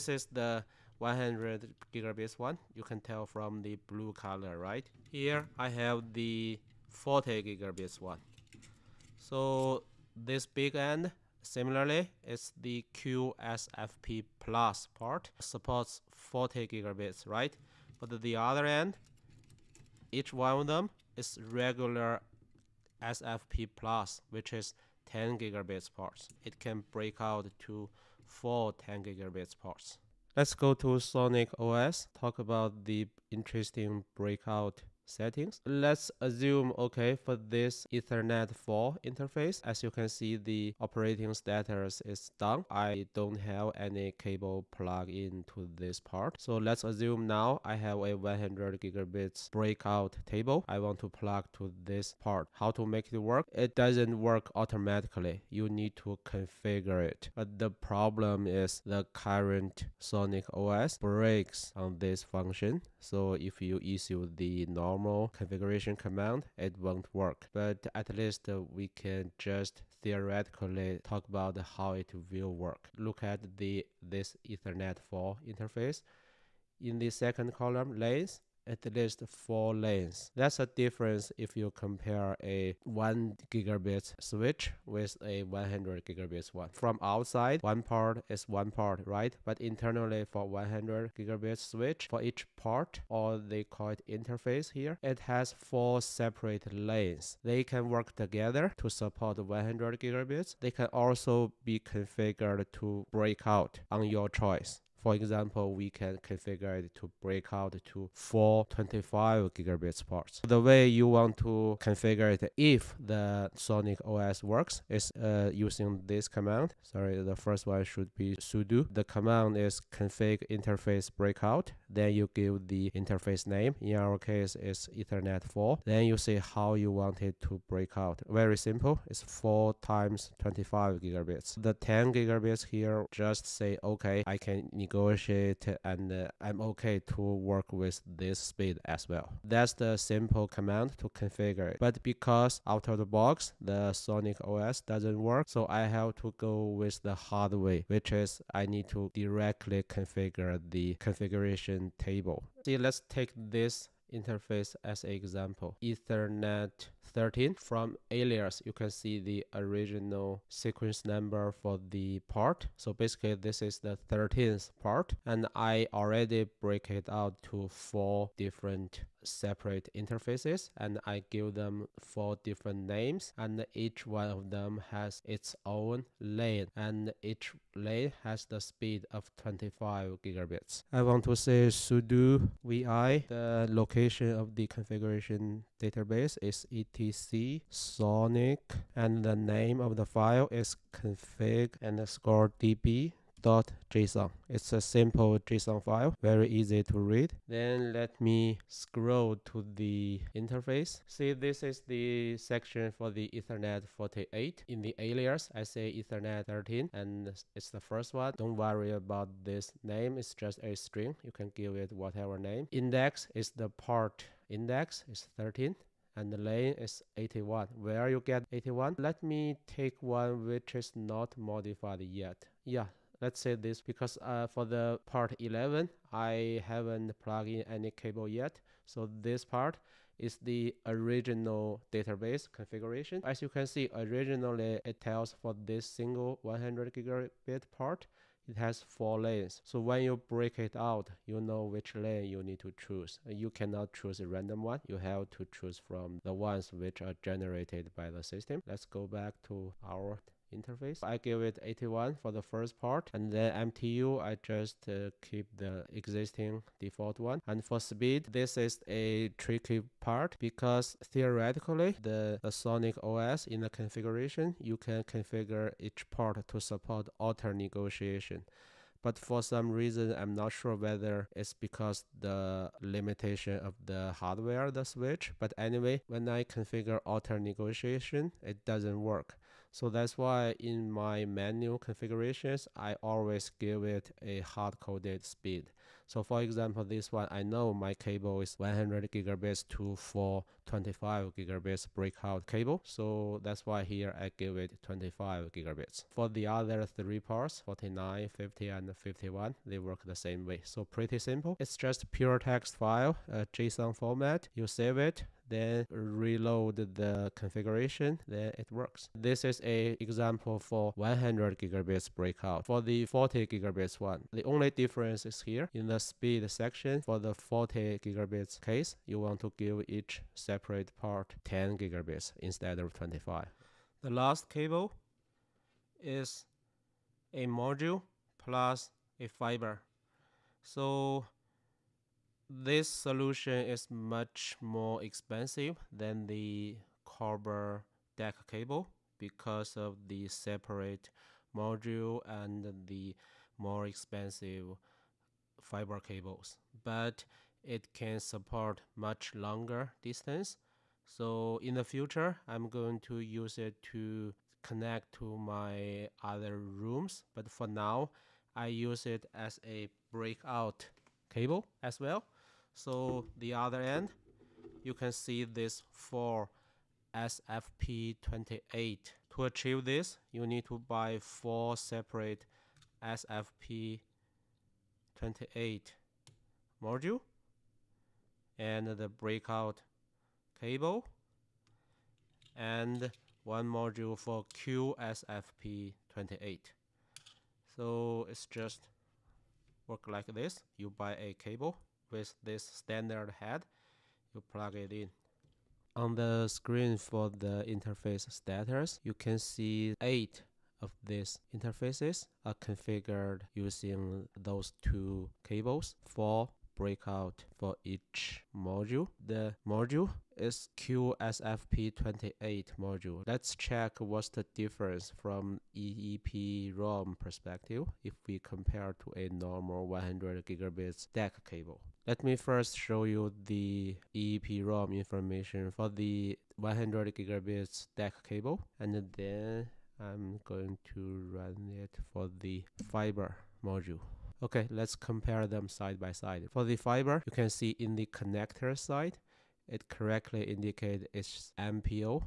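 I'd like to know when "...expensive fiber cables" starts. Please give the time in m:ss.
5:43.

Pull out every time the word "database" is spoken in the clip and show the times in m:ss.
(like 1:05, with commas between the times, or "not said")
3:05, 3:51.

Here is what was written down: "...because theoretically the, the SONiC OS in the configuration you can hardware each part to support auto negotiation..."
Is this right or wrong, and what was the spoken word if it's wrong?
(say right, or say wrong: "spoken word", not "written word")
wrong: "configure", not "hardware".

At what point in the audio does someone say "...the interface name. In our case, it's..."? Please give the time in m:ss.
2:02.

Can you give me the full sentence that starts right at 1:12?
Look at the this Ethernet 4 interface.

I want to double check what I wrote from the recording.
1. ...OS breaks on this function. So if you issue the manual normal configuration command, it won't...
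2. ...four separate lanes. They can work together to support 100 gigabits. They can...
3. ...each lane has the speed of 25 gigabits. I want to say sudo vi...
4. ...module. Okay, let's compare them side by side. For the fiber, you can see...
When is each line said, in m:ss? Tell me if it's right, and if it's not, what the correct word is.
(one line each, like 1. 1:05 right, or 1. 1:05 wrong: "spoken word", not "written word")
1. 1:00 wrong: "normal", not "manual"
2. 1:35 right
3. 2:57 right
4. 7:13 right.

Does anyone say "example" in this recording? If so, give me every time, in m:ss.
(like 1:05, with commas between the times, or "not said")
1:45, 2:35, 4:46, 5:09.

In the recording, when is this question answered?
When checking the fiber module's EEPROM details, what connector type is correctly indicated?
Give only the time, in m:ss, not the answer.
7:21.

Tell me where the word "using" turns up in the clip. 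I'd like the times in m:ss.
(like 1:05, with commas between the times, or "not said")
1:55, 6:43.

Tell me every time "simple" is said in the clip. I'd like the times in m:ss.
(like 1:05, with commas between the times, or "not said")
2:08, 2:19, 3:14, 5:01.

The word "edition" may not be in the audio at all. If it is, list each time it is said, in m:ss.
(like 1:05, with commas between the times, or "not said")
not said.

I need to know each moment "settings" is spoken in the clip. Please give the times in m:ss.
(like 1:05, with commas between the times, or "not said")
0:35.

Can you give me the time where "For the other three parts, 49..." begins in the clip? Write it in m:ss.
4:56.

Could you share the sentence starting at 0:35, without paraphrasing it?
Let's assume, okay, for this Ethernet 4 interface, as you can see, the operating status is done.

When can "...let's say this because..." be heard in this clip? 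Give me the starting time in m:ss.
3:43.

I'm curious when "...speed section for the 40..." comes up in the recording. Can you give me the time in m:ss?
5:15.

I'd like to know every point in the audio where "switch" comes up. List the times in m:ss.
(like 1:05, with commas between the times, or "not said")
1:24, 1:31, 4:34.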